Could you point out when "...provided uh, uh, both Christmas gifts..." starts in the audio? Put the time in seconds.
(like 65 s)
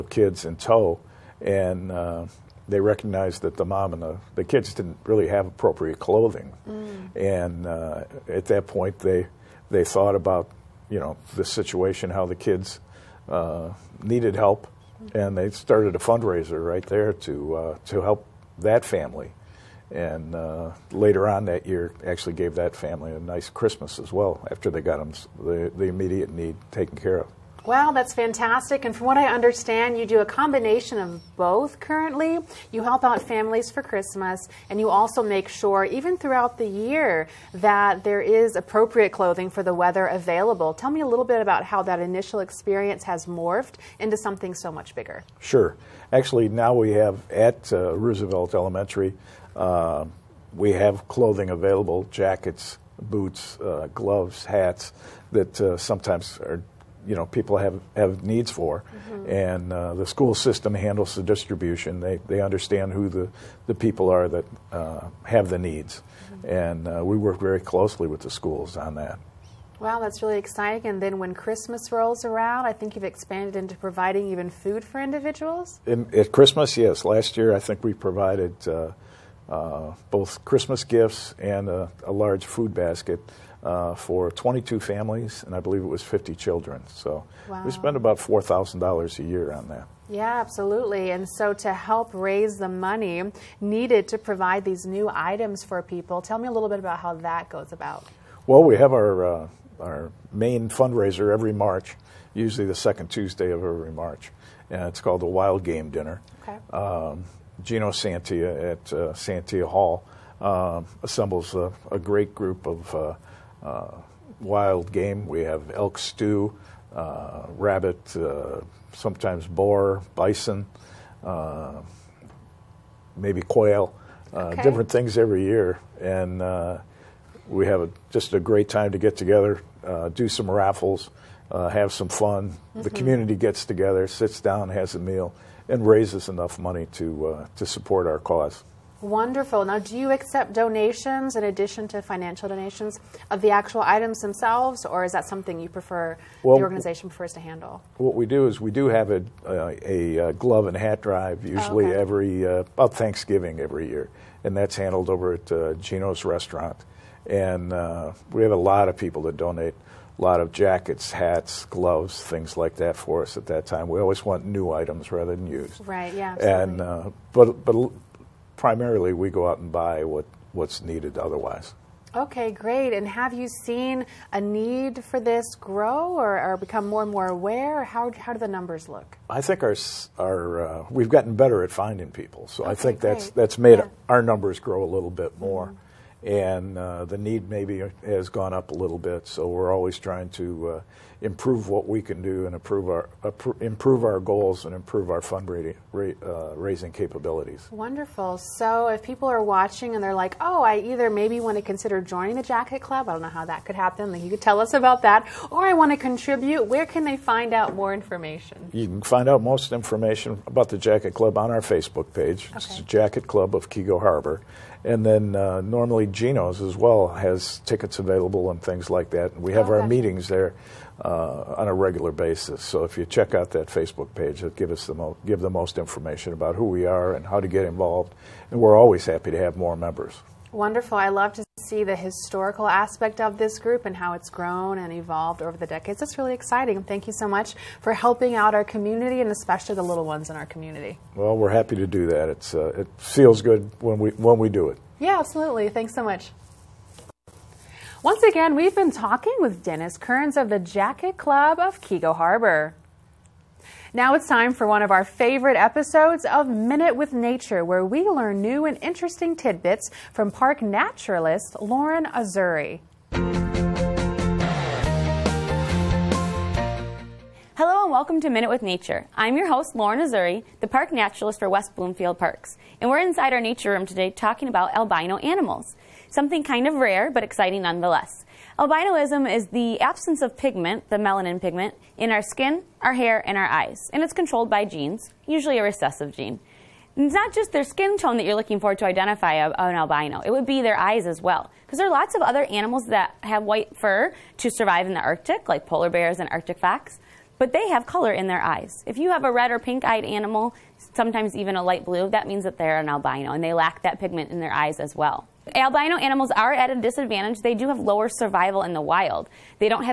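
77 s.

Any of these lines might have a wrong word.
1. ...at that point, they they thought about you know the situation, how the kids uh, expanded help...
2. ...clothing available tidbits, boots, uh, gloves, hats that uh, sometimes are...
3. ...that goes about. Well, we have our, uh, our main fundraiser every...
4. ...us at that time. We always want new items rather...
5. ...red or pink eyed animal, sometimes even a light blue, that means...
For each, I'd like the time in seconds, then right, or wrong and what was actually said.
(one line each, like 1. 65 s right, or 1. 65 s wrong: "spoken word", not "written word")
1. 8 s wrong: "needed", not "expanded"
2. 51 s wrong: "jackets", not "tidbits"
3. 97 s right
4. 163 s right
5. 299 s right.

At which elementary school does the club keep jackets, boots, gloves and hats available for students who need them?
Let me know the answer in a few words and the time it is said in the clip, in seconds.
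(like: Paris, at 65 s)
Roosevelt Elementary, at 47 s.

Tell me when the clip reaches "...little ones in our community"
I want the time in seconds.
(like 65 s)
239 s.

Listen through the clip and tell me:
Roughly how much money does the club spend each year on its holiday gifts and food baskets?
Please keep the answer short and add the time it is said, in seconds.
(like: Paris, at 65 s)
$4,000, at 88 s.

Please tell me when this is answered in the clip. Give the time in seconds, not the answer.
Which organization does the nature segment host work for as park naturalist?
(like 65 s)
271 s.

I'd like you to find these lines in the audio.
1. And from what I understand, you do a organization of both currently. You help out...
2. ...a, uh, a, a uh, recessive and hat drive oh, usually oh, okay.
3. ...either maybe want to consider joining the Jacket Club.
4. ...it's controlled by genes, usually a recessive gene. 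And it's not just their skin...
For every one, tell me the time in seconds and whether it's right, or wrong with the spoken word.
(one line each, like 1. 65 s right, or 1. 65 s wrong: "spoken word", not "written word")
1. 28 s wrong: "combination", not "organization"
2. 149 s wrong: "glove", not "recessive"
3. 200 s right
4. 284 s right.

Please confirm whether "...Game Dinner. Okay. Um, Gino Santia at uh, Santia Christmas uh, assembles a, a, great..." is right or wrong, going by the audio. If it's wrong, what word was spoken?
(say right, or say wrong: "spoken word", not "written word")
wrong: "Hall", not "Christmas".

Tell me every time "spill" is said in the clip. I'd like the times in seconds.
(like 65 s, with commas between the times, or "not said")
not said.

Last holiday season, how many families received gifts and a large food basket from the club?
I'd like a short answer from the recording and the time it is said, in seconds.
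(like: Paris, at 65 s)
22, at 84 s.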